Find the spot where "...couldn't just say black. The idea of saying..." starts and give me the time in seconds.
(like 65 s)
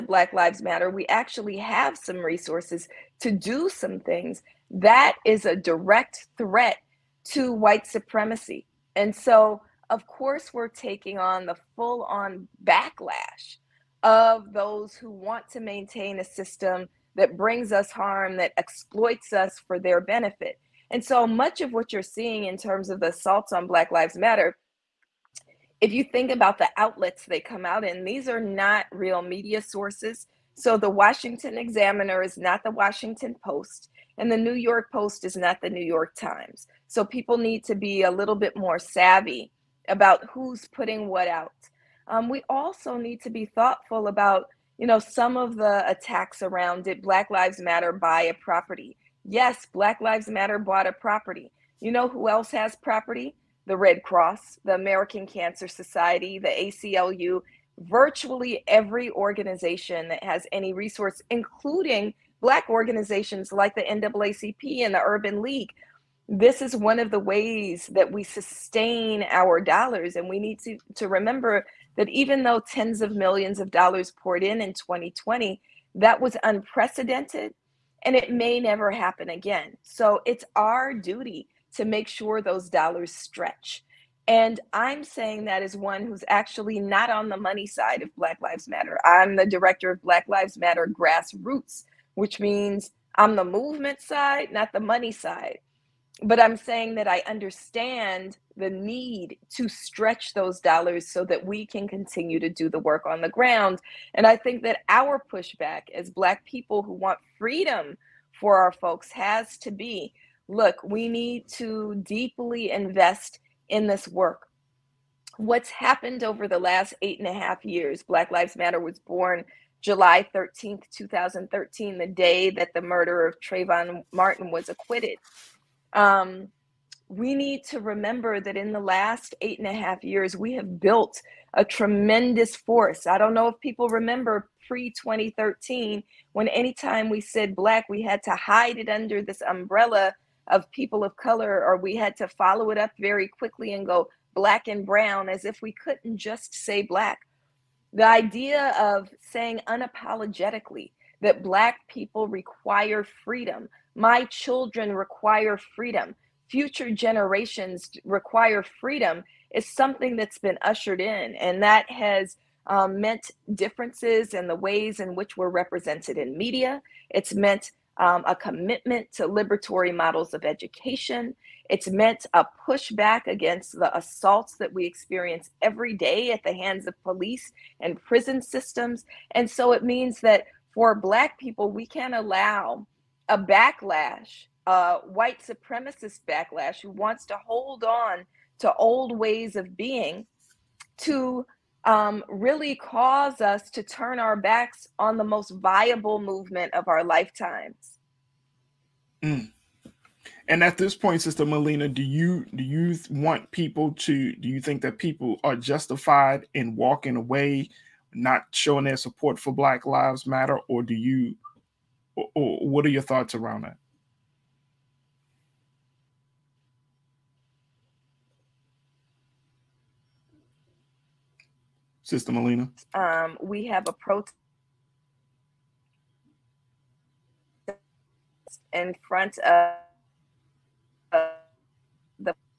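145 s.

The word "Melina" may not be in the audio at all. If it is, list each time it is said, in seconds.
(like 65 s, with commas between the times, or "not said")
201 s, 222 s.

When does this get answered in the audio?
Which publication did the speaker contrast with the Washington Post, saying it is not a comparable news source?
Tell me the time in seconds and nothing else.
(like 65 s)
30 s.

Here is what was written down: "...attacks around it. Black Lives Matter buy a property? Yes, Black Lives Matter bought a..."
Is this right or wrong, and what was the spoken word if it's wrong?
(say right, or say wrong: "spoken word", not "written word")
right.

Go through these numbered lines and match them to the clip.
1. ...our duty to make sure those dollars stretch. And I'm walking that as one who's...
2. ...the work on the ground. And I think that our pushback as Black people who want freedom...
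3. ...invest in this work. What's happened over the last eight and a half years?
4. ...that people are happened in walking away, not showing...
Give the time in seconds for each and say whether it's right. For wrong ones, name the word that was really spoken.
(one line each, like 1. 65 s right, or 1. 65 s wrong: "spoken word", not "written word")
1. 80 s wrong: "saying", not "walking"
2. 102 s right
3. 112 s right
4. 204 s wrong: "justified", not "happened".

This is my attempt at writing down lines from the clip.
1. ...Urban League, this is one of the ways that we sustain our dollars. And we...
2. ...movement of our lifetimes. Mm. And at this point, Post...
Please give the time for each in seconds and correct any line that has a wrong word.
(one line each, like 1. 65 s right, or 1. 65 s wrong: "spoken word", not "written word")
1. 65 s right
2. 196 s wrong: "Sister", not "Post".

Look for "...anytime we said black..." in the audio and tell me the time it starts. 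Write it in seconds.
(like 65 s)
136 s.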